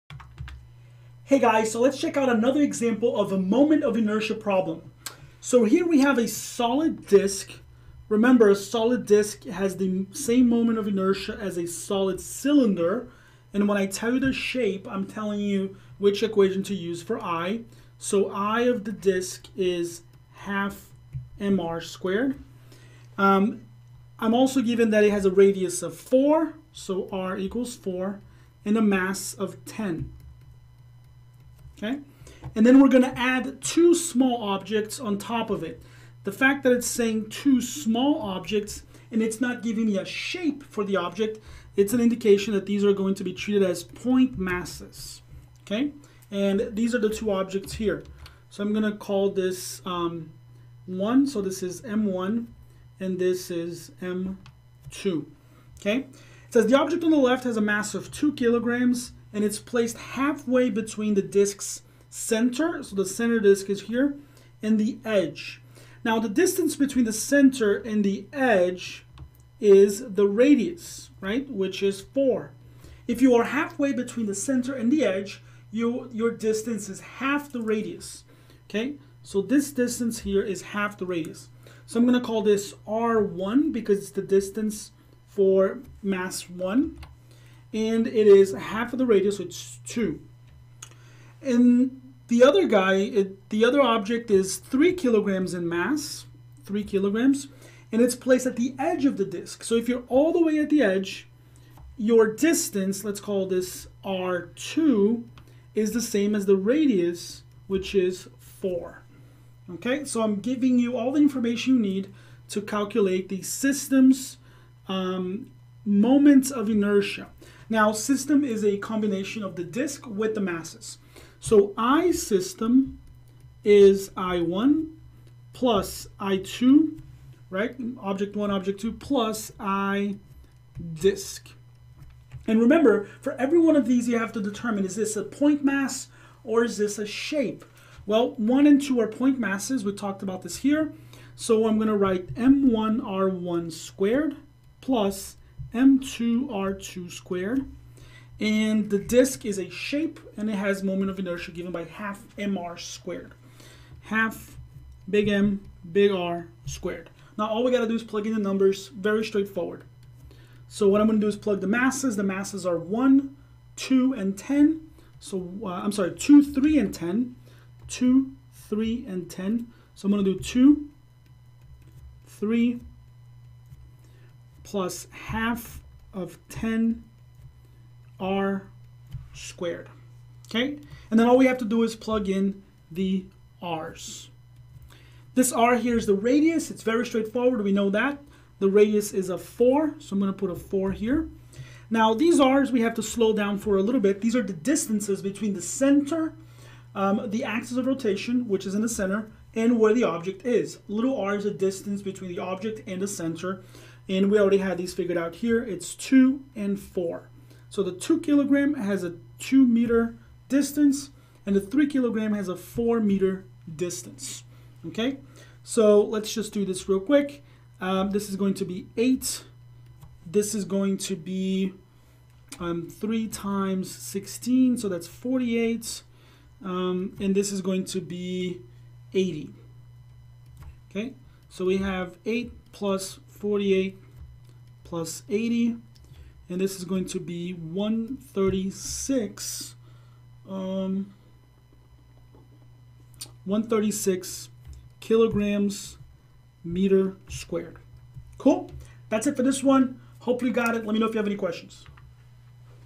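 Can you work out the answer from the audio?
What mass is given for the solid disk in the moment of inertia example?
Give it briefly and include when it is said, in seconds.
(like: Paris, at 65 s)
10, at 28 s.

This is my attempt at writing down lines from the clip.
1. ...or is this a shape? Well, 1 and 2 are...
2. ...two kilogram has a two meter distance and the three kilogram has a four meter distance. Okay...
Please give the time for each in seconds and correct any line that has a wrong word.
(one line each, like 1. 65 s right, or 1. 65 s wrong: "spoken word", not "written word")
1. 136 s right
2. 207 s right.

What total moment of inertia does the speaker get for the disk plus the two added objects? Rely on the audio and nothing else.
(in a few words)
136 kg·m².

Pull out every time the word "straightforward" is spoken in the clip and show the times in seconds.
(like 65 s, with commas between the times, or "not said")
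159 s, 187 s.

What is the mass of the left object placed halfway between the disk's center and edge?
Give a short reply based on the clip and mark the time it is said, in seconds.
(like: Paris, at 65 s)
2 kilograms, at 58 s.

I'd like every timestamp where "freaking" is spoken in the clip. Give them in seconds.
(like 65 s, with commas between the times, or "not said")
not said.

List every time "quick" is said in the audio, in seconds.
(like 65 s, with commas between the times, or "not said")
216 s.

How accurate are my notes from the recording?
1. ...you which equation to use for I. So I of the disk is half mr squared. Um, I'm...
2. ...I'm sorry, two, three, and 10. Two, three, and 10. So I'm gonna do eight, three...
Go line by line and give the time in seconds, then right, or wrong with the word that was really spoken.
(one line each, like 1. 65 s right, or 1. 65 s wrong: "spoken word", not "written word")
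1. 15 s right
2. 165 s wrong: "two", not "eight".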